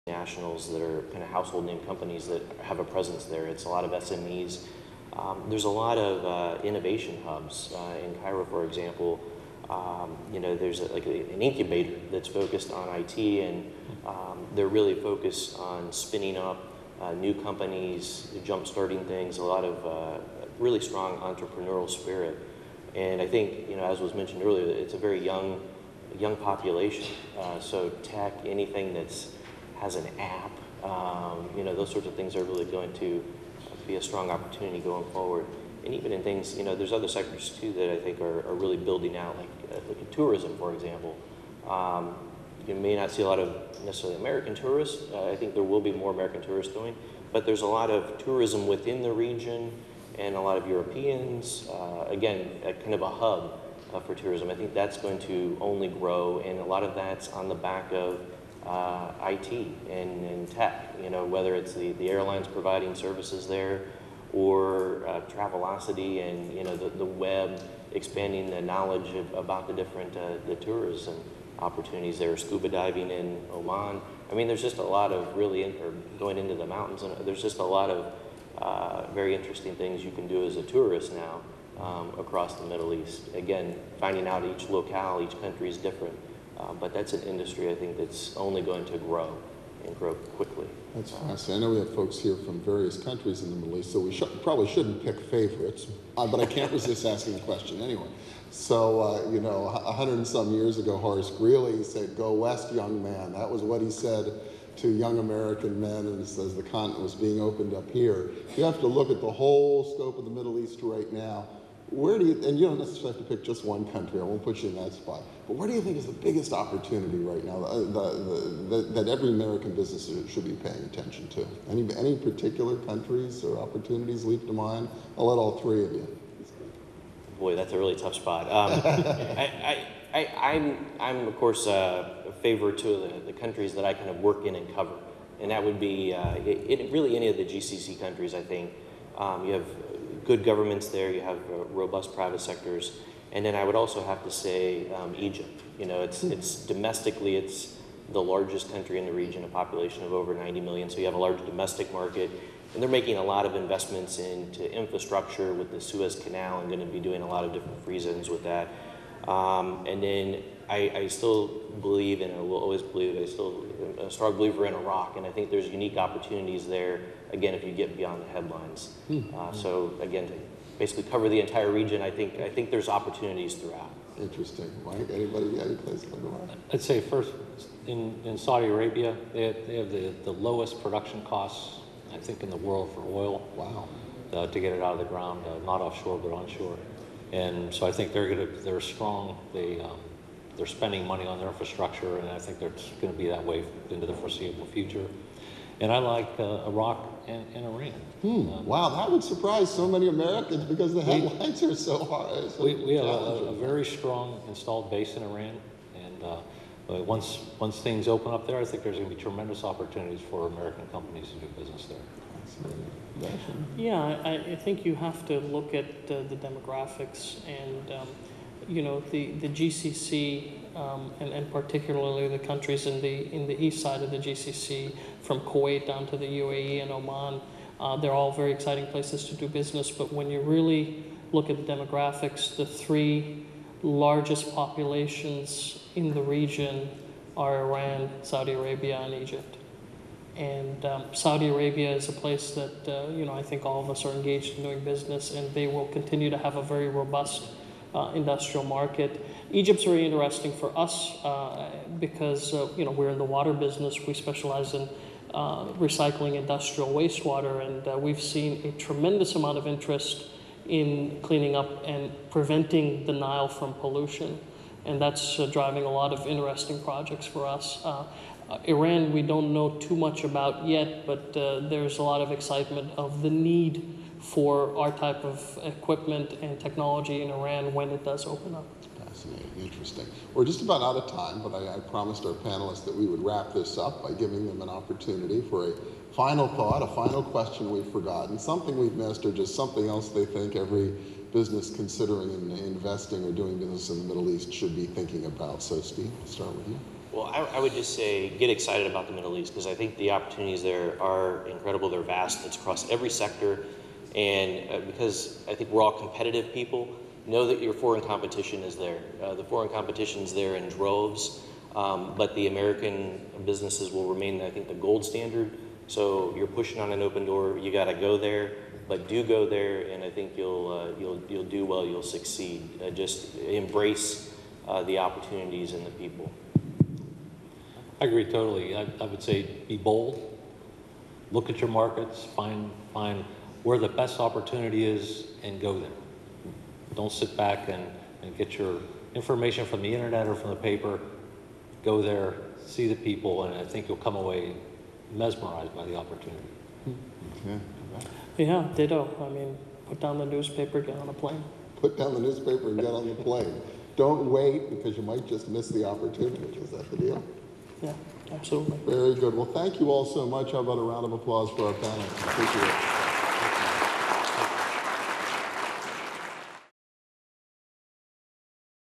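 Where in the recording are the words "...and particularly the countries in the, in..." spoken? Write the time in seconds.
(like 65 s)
221 s.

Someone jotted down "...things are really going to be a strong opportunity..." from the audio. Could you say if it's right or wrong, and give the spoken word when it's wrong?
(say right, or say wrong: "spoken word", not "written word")
right.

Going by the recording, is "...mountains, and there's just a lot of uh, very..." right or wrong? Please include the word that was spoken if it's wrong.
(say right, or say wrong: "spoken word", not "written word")
right.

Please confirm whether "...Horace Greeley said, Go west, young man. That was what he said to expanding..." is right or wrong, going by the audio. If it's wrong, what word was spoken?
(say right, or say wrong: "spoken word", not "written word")
wrong: "young", not "expanding".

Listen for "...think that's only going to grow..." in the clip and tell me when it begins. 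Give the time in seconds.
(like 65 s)
87 s.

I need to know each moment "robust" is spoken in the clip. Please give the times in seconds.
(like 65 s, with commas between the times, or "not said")
141 s, 246 s.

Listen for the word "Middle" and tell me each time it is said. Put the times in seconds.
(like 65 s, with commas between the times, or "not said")
82 s, 93 s, 110 s, 294 s, 299 s.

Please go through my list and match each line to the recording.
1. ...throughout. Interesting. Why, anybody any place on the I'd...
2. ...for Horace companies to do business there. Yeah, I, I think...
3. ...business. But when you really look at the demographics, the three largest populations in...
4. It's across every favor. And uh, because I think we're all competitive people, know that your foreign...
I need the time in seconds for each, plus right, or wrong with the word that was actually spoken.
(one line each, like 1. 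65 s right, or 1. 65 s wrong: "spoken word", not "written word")
1. 173 s right
2. 210 s wrong: "American", not "Horace"
3. 229 s right
4. 302 s wrong: "sector", not "favor".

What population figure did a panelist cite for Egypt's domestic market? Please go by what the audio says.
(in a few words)
over 90 million.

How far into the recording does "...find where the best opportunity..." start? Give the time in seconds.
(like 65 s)
332 s.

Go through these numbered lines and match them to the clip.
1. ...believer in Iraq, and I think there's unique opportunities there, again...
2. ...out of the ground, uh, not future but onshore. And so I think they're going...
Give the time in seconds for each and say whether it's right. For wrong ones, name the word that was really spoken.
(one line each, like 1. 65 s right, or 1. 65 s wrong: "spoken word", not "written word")
1. 164 s right
2. 184 s wrong: "offshore", not "future".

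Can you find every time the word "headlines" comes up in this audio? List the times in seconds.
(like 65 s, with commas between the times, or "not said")
168 s, 201 s.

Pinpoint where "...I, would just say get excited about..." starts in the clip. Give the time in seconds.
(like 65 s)
297 s.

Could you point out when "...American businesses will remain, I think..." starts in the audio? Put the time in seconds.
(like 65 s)
312 s.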